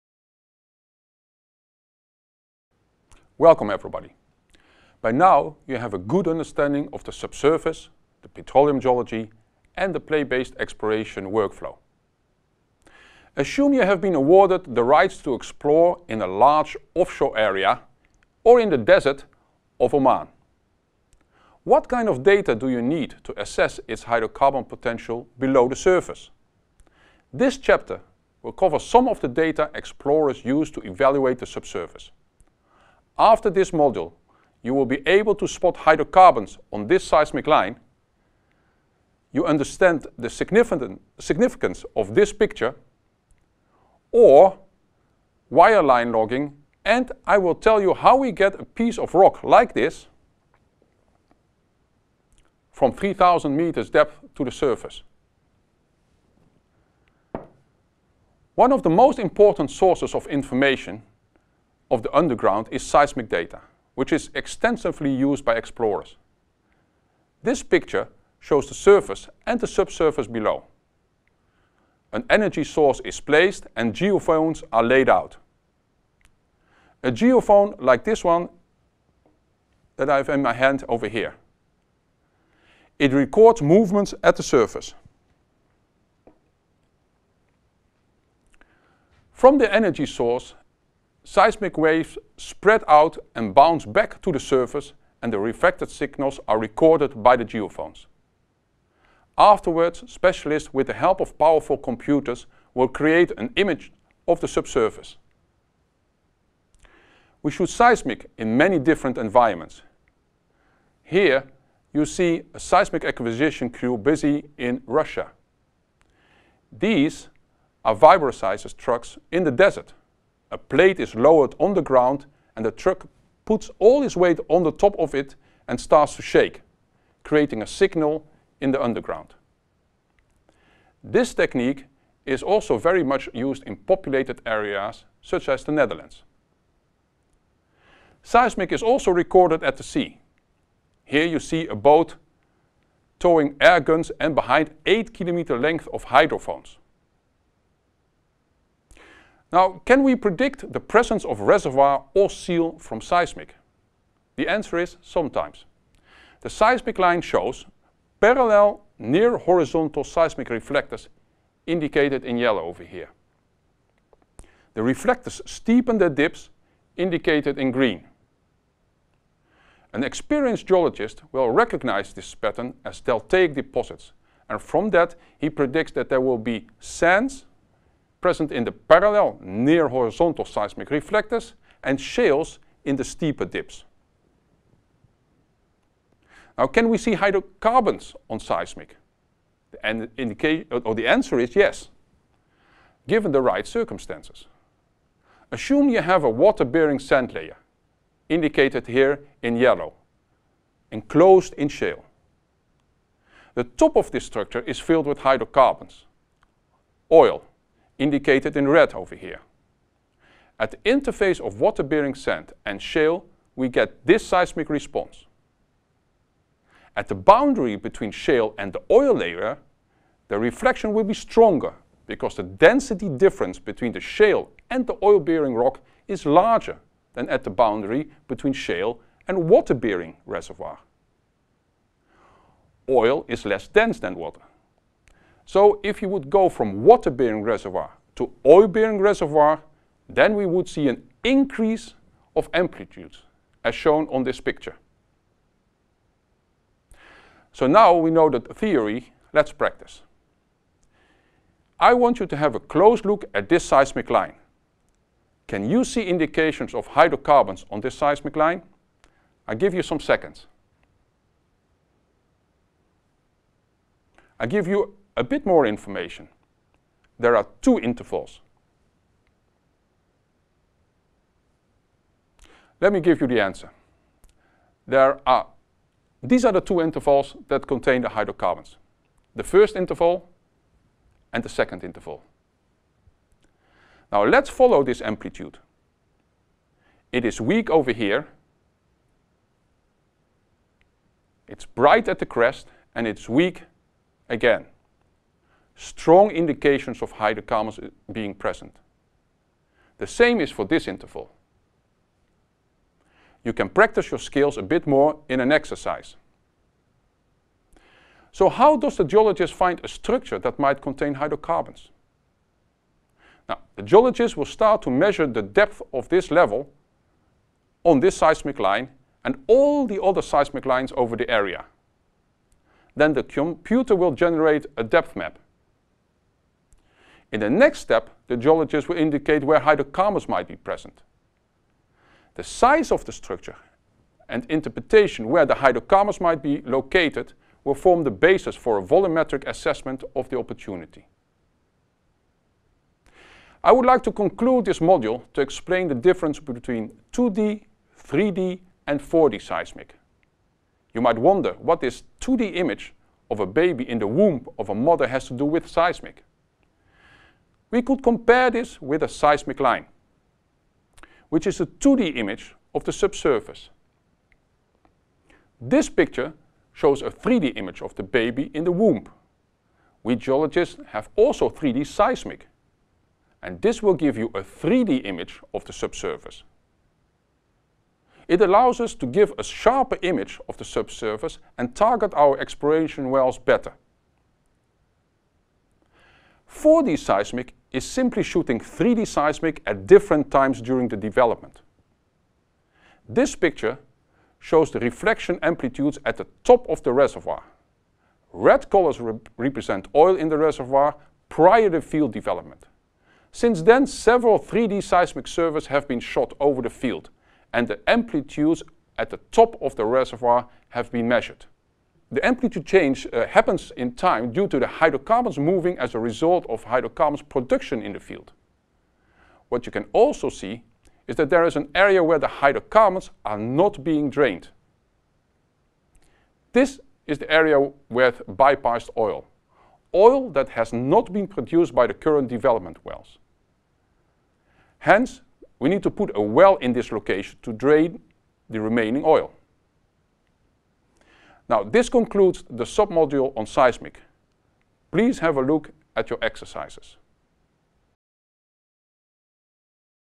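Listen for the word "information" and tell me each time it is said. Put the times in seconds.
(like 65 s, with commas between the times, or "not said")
60 s, 265 s.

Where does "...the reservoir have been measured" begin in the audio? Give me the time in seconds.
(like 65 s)
409 s.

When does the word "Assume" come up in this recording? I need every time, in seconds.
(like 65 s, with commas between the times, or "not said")
13 s, 195 s.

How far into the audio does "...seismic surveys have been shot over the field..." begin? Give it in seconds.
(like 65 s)
404 s.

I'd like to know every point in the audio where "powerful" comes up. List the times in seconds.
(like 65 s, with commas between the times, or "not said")
101 s.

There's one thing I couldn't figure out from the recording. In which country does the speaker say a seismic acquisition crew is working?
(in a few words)
Russia.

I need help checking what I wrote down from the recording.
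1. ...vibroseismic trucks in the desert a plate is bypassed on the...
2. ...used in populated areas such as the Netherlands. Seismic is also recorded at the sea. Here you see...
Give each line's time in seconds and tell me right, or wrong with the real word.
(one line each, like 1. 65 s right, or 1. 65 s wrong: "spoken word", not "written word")
1. 117 s wrong: "lowered", not "bypassed"
2. 133 s right.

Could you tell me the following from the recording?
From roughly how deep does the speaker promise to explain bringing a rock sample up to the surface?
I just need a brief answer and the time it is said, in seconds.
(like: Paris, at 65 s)
3000 meters, at 52 s.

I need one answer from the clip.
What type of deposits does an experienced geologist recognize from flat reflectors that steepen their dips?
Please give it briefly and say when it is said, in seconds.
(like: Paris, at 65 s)
Deltaic deposits, at 173 s.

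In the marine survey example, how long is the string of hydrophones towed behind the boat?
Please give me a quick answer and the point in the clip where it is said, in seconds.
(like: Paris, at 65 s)
8 kilometers, at 144 s.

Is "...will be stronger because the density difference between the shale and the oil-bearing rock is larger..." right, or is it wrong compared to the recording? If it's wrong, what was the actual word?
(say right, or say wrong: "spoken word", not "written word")
right.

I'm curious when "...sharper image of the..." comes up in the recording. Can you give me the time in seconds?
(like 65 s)
379 s.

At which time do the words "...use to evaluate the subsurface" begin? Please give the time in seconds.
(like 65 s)
30 s.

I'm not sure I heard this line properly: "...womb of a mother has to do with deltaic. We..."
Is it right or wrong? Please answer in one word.
wrong.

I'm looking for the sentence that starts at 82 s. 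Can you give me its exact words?
It records movements at the surface.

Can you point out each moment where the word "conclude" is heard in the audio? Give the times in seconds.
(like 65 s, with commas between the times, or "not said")
344 s, 441 s.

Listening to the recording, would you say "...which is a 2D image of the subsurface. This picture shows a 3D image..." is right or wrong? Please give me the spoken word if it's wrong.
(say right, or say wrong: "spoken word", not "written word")
right.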